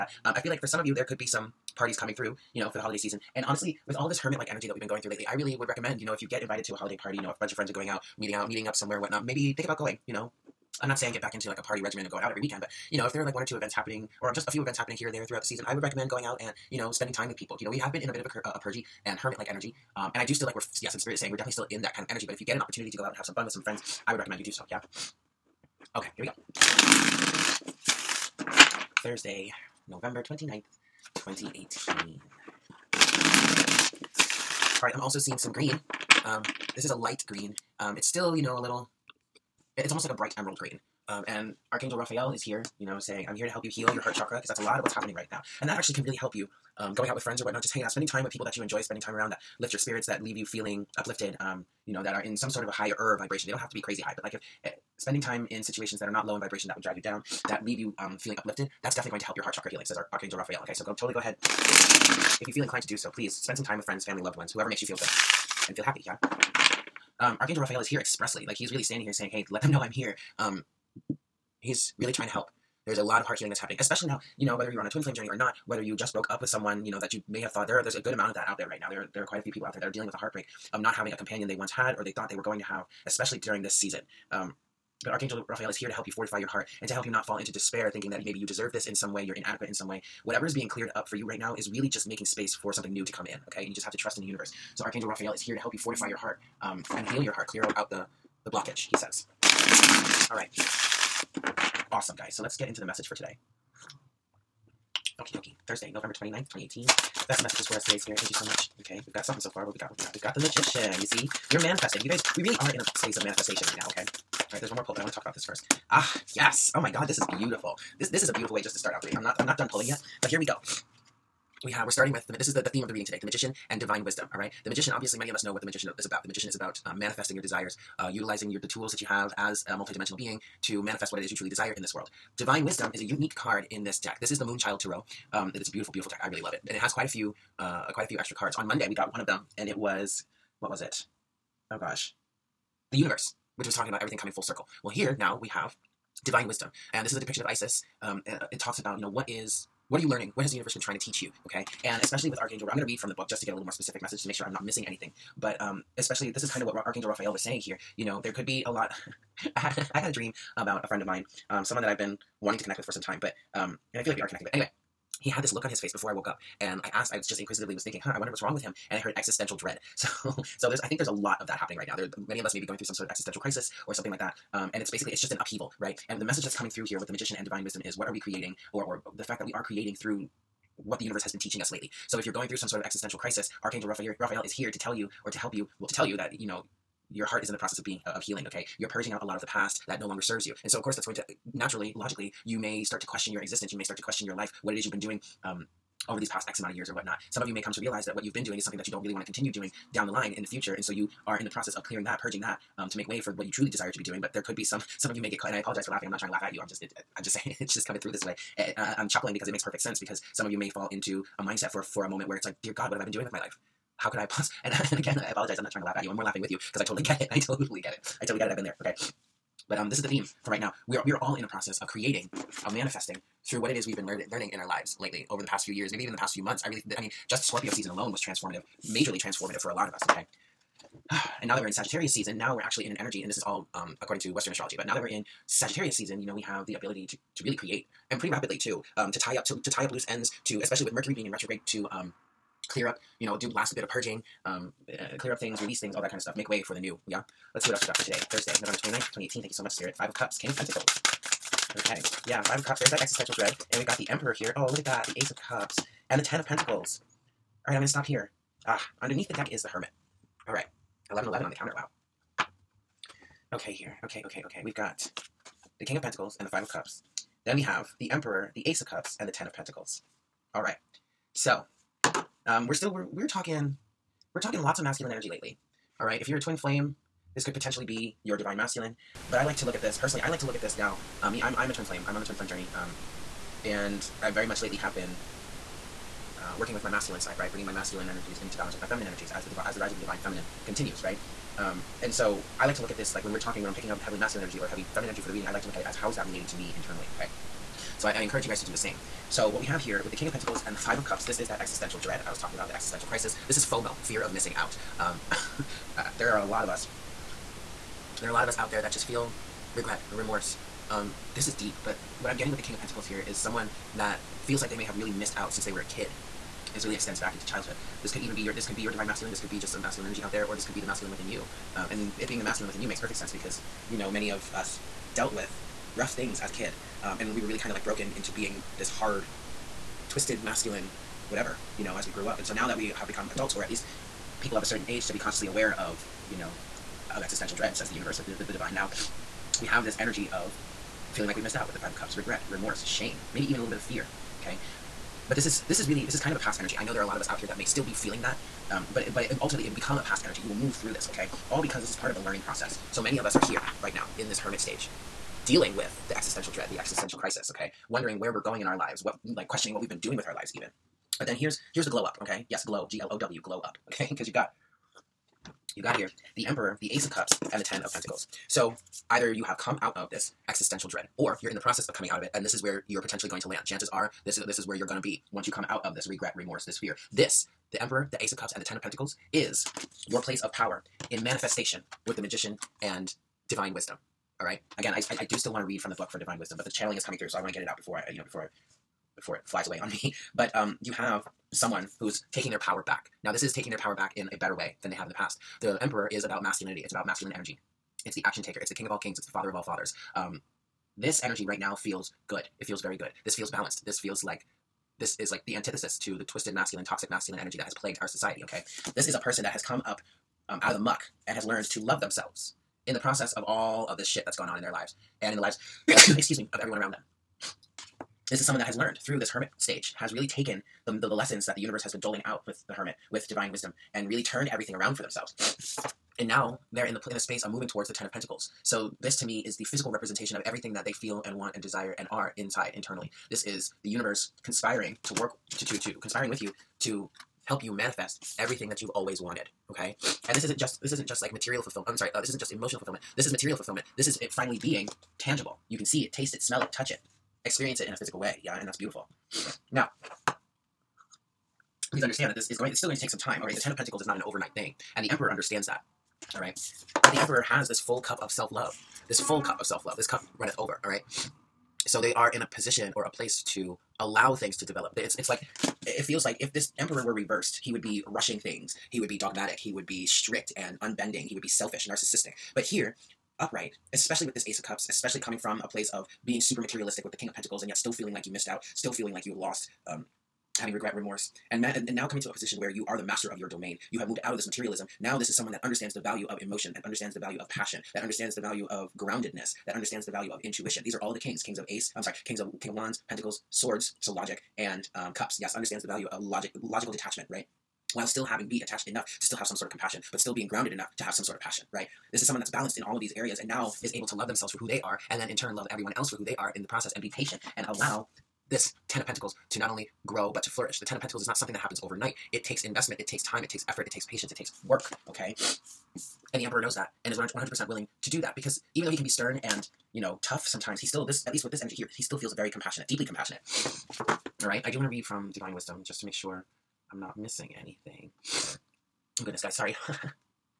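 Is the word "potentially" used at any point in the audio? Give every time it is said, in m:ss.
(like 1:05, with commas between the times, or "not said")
4:37, 6:13.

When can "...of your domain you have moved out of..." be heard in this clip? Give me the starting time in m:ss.
8:03.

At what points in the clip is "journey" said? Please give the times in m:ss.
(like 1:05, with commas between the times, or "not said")
1:15, 4:42.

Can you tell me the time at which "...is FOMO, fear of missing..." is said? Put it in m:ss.
5:03.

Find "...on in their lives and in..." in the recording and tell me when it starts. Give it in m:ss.
6:54.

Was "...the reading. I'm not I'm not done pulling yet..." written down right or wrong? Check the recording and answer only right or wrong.
right.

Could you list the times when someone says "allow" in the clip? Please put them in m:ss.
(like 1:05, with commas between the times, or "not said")
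7:43, 8:27.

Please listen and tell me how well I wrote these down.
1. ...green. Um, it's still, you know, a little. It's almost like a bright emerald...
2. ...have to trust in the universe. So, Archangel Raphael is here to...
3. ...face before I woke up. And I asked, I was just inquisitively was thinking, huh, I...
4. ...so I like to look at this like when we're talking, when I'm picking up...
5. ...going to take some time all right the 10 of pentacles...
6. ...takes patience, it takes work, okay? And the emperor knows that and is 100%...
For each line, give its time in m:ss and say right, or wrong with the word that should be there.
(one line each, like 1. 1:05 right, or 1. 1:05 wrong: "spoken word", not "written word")
1. 0:37 right
2. 1:33 right
3. 2:45 right
4. 4:52 right
5. 7:32 right
6. 8:33 right.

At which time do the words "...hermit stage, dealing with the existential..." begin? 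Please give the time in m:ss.
5:54.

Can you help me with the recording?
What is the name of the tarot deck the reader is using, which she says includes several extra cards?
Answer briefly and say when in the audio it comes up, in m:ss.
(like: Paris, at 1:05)
Moonchild Tarot, at 2:14.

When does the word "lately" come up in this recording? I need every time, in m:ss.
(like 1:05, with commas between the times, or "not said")
0:05, 3:01, 3:44, 4:35, 4:44.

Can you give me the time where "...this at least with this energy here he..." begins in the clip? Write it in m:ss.
8:41.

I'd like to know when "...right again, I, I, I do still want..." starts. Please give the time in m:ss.
6:24.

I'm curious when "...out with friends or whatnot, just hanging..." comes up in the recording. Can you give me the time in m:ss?
0:47.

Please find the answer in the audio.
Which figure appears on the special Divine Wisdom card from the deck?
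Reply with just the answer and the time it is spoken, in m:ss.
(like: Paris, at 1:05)
Isis, at 2:27.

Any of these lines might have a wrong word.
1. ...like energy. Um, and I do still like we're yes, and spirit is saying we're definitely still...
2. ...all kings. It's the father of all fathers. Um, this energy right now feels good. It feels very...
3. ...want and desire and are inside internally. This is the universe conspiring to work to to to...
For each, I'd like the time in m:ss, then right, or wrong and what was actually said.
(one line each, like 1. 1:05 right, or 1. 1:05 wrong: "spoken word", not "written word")
1. 0:19 right
2. 6:38 right
3. 7:11 right.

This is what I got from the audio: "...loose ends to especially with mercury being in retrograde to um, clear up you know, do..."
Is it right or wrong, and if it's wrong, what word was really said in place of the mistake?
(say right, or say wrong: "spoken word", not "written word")
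right.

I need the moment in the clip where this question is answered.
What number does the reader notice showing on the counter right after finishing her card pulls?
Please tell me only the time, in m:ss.
4:21.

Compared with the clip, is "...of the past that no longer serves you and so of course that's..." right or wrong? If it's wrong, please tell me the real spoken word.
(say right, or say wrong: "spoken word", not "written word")
right.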